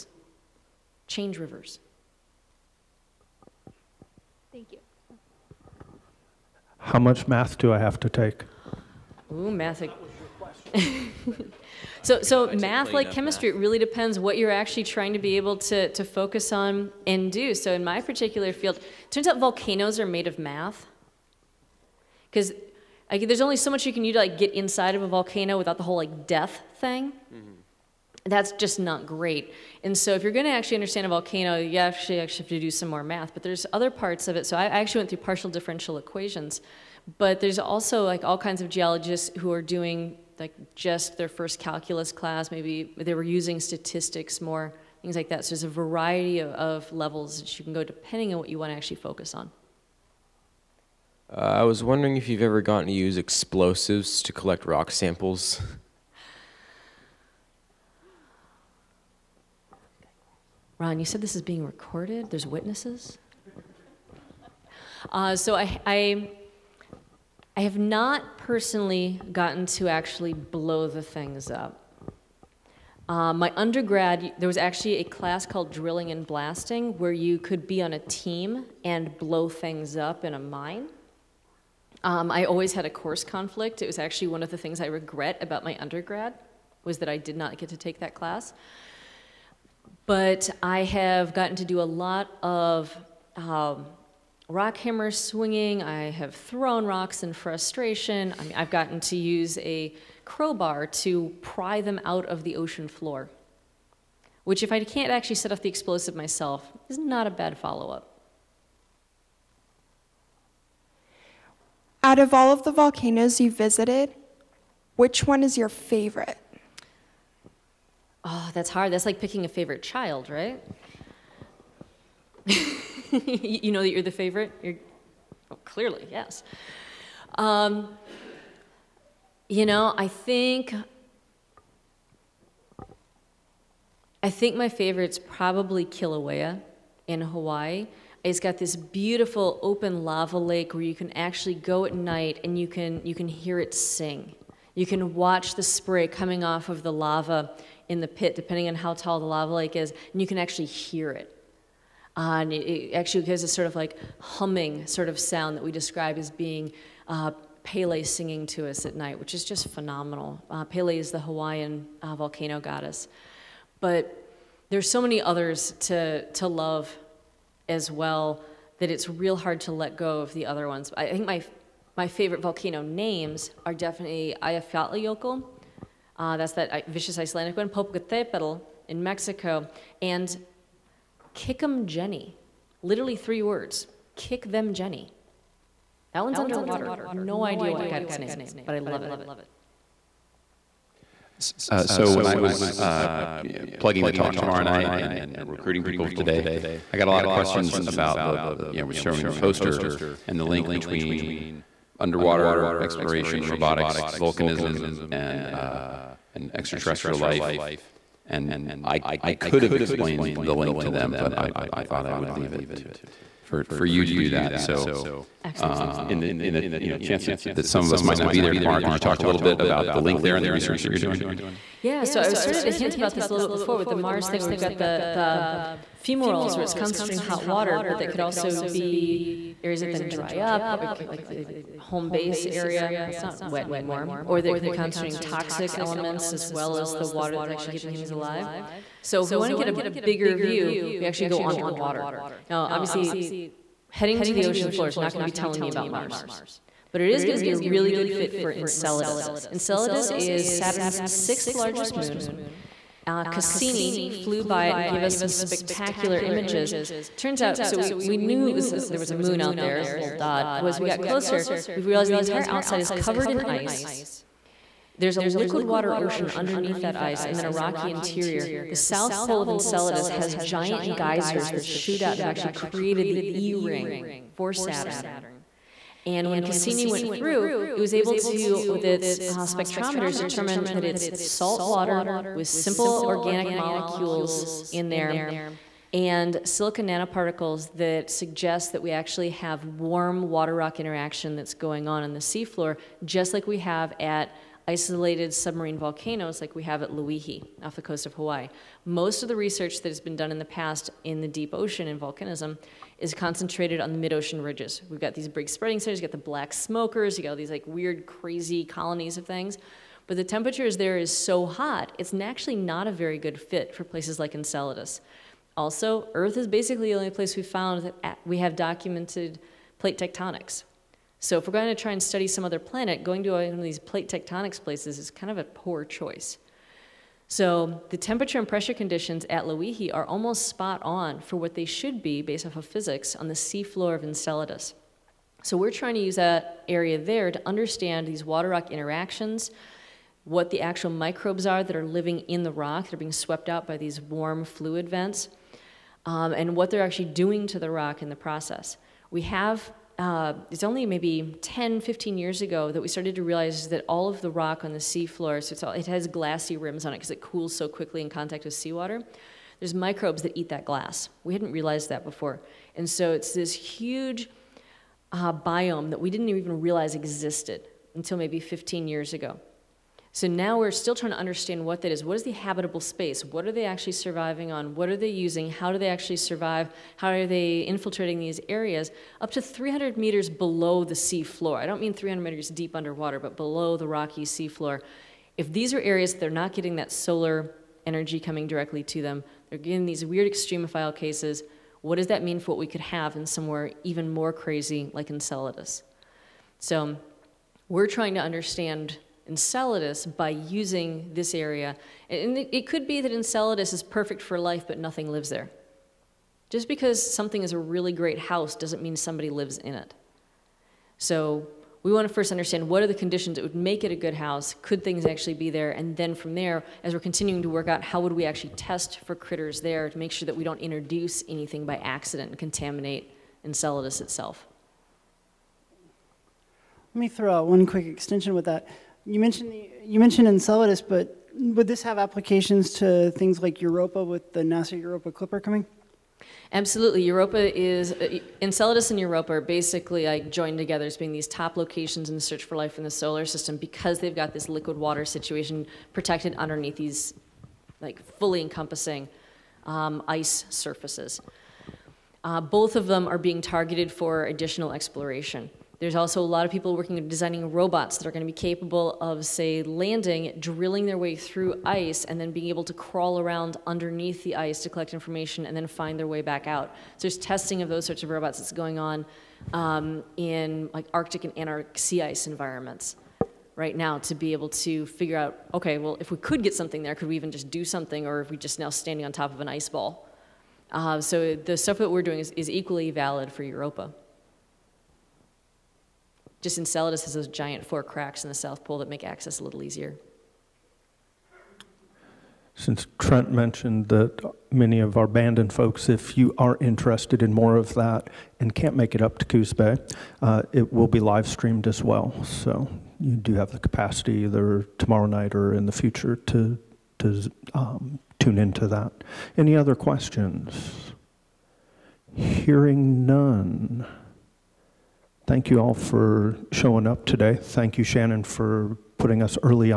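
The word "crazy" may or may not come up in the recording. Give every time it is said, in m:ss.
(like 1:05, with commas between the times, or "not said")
5:08, 6:34.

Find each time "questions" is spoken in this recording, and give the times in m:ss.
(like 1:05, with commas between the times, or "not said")
3:17, 8:29.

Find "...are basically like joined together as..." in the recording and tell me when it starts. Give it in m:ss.
7:19.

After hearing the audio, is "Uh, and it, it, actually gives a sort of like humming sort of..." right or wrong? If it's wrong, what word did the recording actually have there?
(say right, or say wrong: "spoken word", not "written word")
right.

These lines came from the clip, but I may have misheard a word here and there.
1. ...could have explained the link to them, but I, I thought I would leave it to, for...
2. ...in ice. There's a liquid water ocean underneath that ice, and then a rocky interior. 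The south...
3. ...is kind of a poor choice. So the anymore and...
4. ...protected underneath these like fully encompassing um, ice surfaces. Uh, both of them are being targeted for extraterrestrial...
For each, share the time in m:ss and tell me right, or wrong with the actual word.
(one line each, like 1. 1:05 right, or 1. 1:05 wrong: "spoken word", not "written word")
1. 3:29 right
2. 4:23 right
3. 5:24 wrong: "temperature", not "anymore"
4. 7:25 wrong: "additional", not "extraterrestrial".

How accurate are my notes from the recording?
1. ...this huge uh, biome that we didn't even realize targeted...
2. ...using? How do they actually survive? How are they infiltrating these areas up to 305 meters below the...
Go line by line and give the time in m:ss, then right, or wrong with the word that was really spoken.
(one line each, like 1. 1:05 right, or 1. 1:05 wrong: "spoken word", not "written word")
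1. 6:03 wrong: "existed", not "targeted"
2. 6:15 wrong: "300", not "305".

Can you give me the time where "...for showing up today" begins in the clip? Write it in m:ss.
8:35.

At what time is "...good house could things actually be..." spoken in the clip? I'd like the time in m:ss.
6:53.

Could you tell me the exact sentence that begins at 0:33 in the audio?
But there's other parts of it.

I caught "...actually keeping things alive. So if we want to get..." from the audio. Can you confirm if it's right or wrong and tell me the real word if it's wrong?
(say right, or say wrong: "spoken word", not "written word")
right.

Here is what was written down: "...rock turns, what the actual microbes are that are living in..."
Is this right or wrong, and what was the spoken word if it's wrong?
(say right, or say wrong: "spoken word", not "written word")
wrong: "interactions", not "turns".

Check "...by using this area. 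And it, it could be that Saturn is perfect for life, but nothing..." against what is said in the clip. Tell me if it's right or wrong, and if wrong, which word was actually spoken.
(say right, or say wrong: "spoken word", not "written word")
wrong: "Enceladus", not "Saturn".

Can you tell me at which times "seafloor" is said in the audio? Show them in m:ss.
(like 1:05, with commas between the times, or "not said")
4:52, 5:33, 5:54.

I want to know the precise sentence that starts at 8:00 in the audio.
Uh, so the stuff that we're doing is, is equally valid for Europa.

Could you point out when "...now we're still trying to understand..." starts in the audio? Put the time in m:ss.
6:10.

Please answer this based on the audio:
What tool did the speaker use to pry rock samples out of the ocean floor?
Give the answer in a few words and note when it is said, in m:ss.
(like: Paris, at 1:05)
A crowbar, at 1:40.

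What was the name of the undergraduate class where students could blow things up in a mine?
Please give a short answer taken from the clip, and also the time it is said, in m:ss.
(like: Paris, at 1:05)
Drilling and blasting, at 1:15.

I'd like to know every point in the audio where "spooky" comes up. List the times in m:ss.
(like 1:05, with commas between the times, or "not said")
not said.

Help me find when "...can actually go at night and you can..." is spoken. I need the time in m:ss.
2:20.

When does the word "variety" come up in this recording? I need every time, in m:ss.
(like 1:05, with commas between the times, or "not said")
0:45.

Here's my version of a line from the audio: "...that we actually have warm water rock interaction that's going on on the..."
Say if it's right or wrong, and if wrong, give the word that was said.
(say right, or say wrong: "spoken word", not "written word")
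right.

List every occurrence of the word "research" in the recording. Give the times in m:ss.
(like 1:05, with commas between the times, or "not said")
3:40, 4:59.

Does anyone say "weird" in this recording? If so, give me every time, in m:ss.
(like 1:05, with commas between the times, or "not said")
5:07, 6:30.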